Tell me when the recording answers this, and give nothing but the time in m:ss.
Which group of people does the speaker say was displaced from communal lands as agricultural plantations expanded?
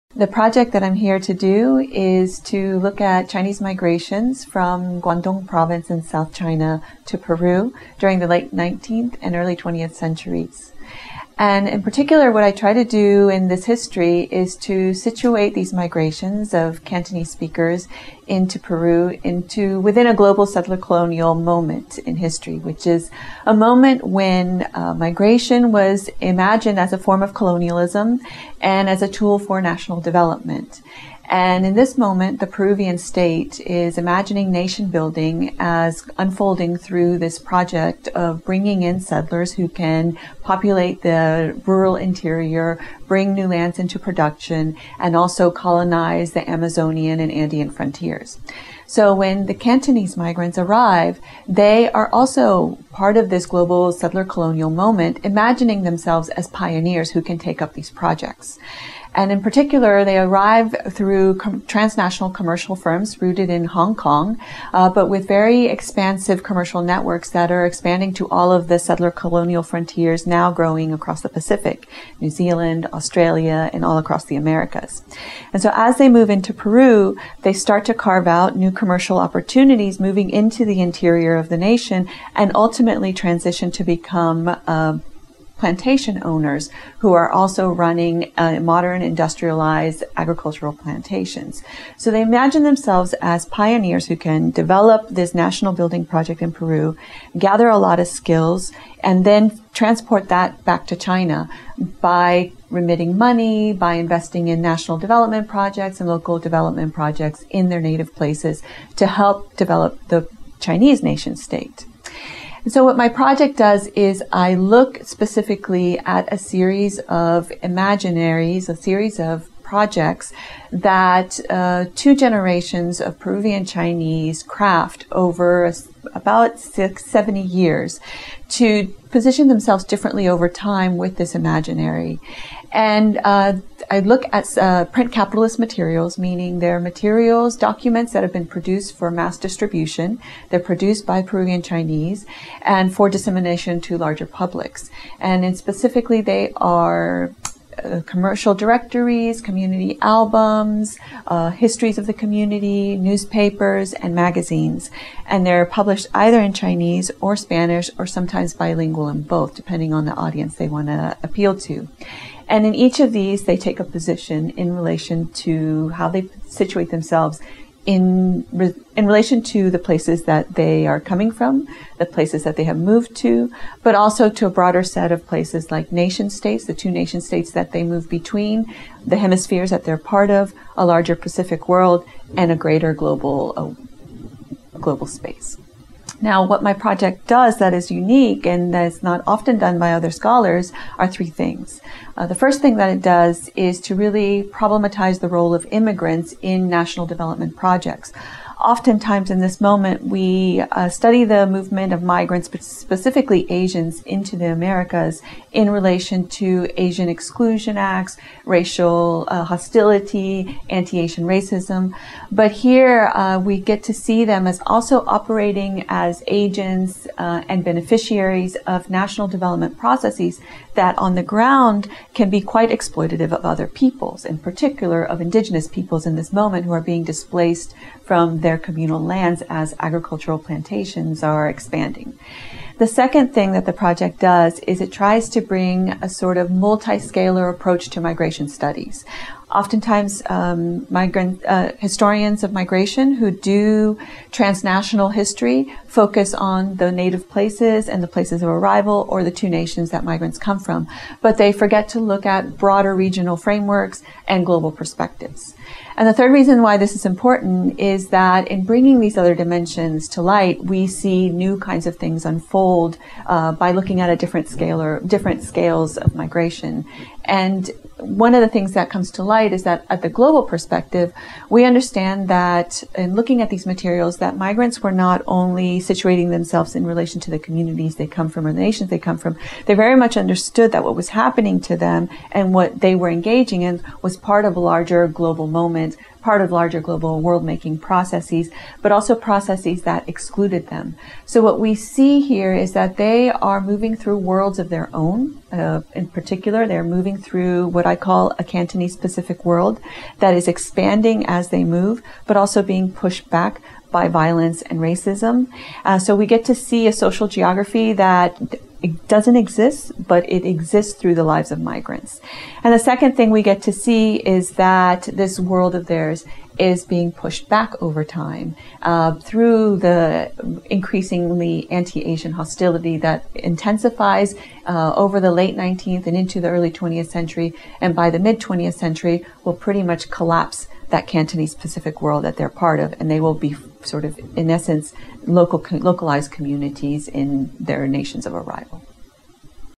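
3:45.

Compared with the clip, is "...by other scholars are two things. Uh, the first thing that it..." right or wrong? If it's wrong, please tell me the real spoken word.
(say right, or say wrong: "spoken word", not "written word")
wrong: "three", not "two".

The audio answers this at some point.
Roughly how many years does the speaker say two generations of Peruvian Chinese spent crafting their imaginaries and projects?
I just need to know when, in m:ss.
2:06.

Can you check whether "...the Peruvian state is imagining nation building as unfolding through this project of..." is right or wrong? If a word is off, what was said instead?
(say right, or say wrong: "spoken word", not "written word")
right.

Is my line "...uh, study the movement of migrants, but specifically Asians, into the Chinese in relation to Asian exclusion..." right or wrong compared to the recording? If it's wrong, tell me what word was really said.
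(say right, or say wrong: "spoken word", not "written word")
wrong: "Americas", not "Chinese".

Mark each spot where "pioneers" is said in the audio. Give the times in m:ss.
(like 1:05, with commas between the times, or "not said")
0:56, 1:33.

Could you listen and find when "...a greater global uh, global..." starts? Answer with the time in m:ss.
3:02.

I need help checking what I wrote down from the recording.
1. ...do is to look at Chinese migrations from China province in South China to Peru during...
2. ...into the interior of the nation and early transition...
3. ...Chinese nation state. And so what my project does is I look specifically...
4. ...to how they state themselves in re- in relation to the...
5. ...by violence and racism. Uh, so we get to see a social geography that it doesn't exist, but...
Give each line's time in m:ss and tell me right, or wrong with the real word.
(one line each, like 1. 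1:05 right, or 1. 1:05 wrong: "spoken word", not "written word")
1. 0:01 wrong: "Guangdong", not "China"
2. 1:20 wrong: "ultimately", not "early"
3. 1:50 right
4. 2:45 wrong: "situate", not "state"
5. 5:03 right.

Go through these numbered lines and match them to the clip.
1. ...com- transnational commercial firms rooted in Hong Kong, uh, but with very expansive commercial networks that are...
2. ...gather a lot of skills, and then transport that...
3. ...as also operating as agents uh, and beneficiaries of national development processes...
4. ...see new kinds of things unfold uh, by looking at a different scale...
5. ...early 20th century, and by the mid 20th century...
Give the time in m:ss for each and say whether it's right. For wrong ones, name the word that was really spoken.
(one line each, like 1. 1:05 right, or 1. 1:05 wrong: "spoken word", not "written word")
1. 1:01 right
2. 1:37 right
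3. 3:34 right
4. 4:20 right
5. 5:26 right.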